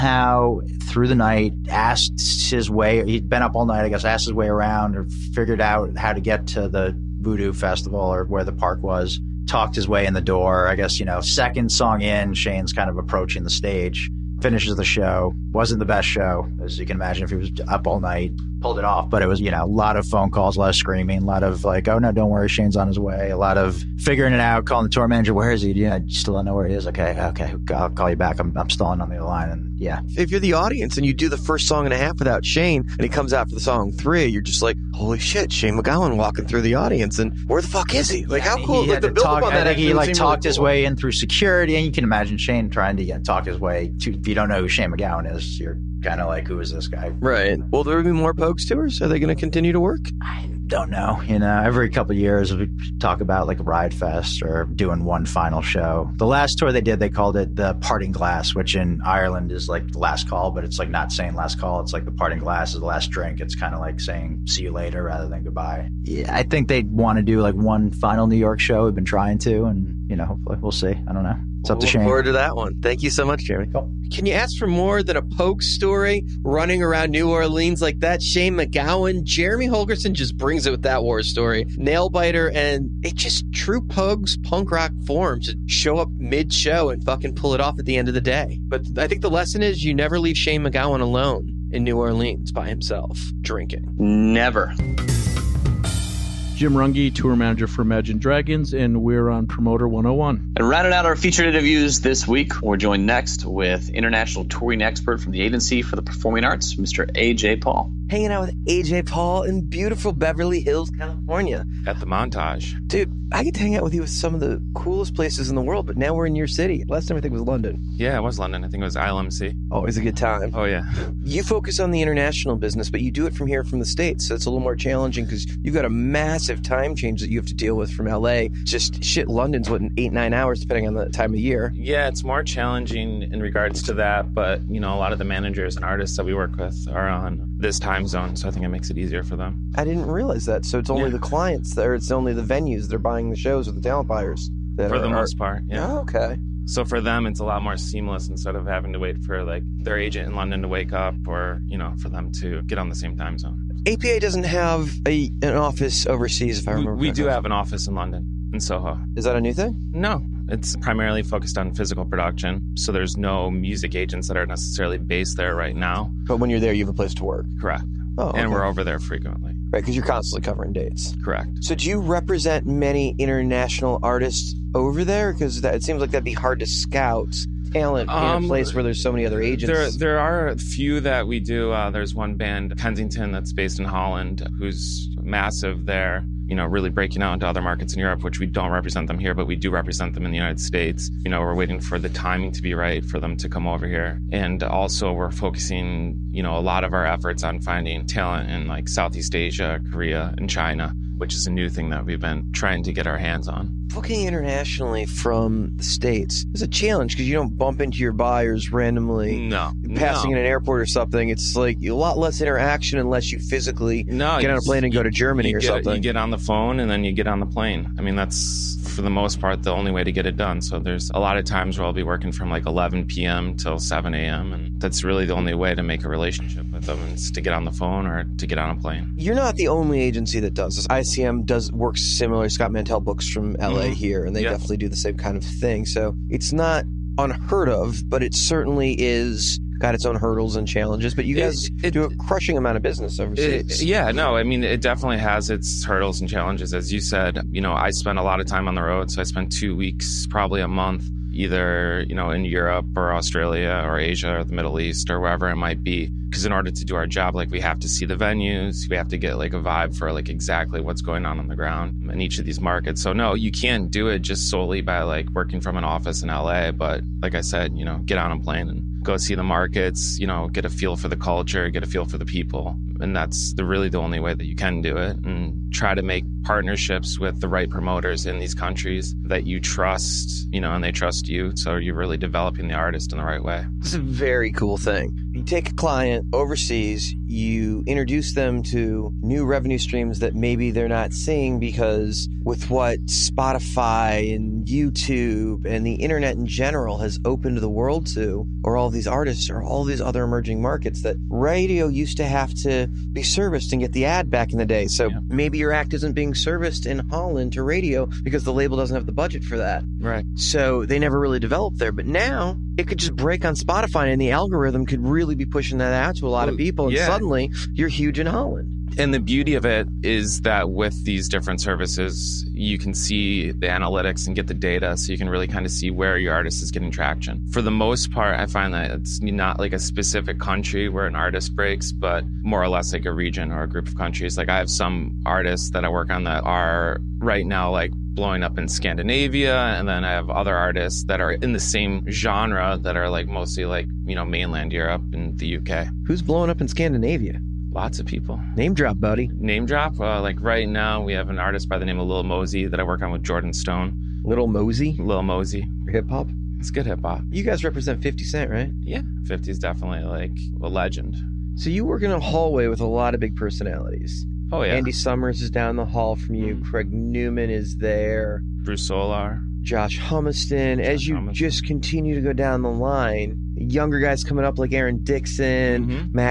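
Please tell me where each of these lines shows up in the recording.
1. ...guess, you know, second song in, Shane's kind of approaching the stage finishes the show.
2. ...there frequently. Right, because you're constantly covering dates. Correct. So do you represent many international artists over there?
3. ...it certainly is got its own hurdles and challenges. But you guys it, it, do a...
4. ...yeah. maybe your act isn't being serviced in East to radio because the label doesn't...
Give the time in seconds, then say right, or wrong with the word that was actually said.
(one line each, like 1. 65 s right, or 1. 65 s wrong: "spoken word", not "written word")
1. 10 s right
2. 168 s right
3. 238 s right
4. 305 s wrong: "Holland", not "East".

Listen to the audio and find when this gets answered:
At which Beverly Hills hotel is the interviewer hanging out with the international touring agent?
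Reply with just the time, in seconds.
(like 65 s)
111 s.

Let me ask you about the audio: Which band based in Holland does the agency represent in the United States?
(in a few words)
Kensington.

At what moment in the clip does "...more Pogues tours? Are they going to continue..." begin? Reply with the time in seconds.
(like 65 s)
48 s.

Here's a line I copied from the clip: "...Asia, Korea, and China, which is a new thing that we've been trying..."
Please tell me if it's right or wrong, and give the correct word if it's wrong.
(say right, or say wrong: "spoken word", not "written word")
right.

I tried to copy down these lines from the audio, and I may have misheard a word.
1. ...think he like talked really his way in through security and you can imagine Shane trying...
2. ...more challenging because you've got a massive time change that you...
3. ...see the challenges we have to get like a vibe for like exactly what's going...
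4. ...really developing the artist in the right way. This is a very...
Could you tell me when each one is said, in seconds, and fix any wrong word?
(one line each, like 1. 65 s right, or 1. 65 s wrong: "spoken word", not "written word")
1. 39 s right
2. 124 s right
3. 257 s wrong: "venues", not "challenges"
4. 281 s right.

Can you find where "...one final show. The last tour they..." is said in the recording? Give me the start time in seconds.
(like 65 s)
55 s.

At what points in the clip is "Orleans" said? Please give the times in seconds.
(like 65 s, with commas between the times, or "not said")
77 s, 91 s.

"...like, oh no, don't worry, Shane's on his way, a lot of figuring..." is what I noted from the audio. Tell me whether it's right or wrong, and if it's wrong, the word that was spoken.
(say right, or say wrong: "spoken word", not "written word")
right.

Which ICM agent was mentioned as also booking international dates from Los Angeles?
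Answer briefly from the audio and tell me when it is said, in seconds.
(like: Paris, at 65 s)
Scott Mantell, at 232 s.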